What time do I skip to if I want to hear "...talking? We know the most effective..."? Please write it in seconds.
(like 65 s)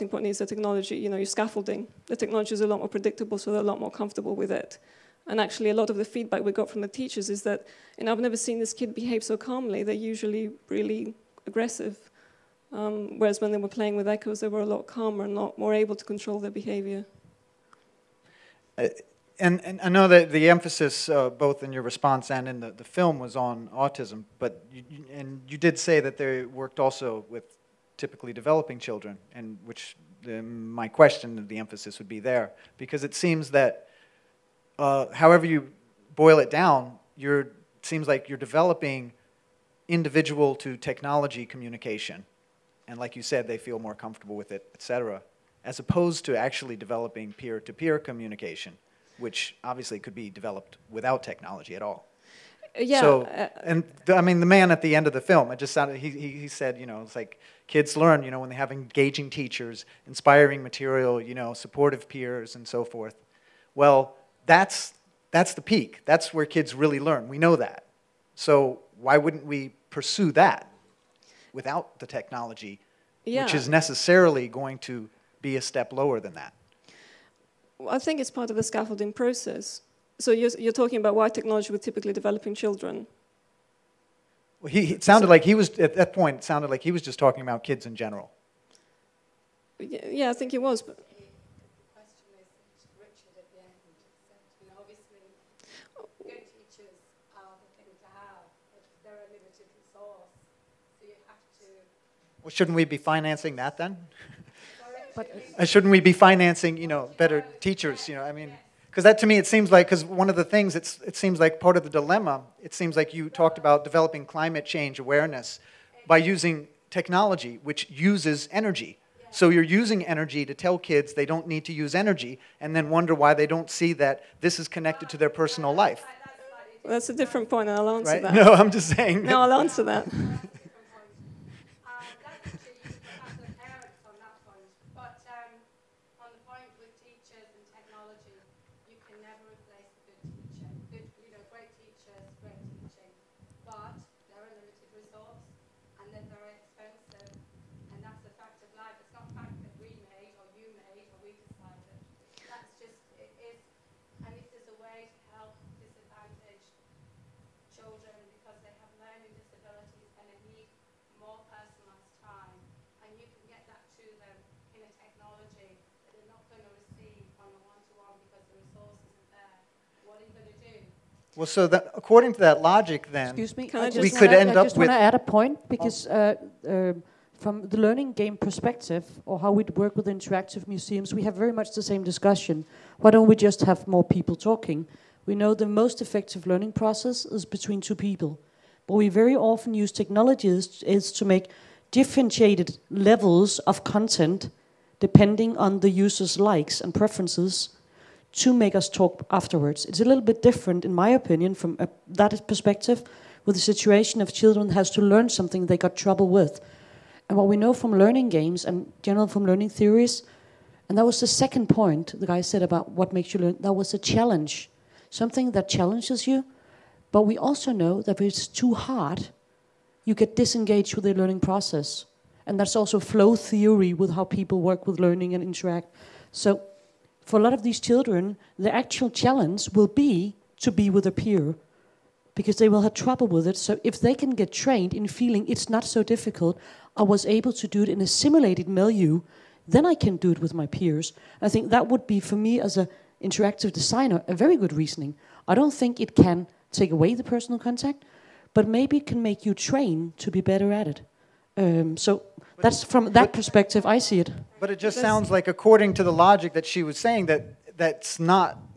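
184 s.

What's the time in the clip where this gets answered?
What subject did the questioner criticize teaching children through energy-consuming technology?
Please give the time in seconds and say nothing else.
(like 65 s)
114 s.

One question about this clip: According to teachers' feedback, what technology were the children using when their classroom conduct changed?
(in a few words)
ECHOES.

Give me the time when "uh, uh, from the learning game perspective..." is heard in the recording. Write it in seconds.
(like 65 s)
176 s.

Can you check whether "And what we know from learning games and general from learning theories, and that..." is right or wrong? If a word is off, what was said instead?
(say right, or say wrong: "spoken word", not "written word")
right.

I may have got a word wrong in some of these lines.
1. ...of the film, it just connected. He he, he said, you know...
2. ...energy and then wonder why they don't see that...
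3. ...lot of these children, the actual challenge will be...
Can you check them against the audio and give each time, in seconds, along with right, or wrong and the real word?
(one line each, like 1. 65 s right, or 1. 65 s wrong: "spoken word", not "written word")
1. 55 s wrong: "sounded", not "connected"
2. 121 s right
3. 227 s right.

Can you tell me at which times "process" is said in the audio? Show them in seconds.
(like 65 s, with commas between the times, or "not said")
79 s, 186 s, 221 s.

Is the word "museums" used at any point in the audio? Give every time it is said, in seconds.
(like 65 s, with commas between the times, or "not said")
180 s.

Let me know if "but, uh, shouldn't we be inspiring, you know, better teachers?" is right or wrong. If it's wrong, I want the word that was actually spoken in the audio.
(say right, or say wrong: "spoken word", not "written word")
wrong: "financing", not "inspiring".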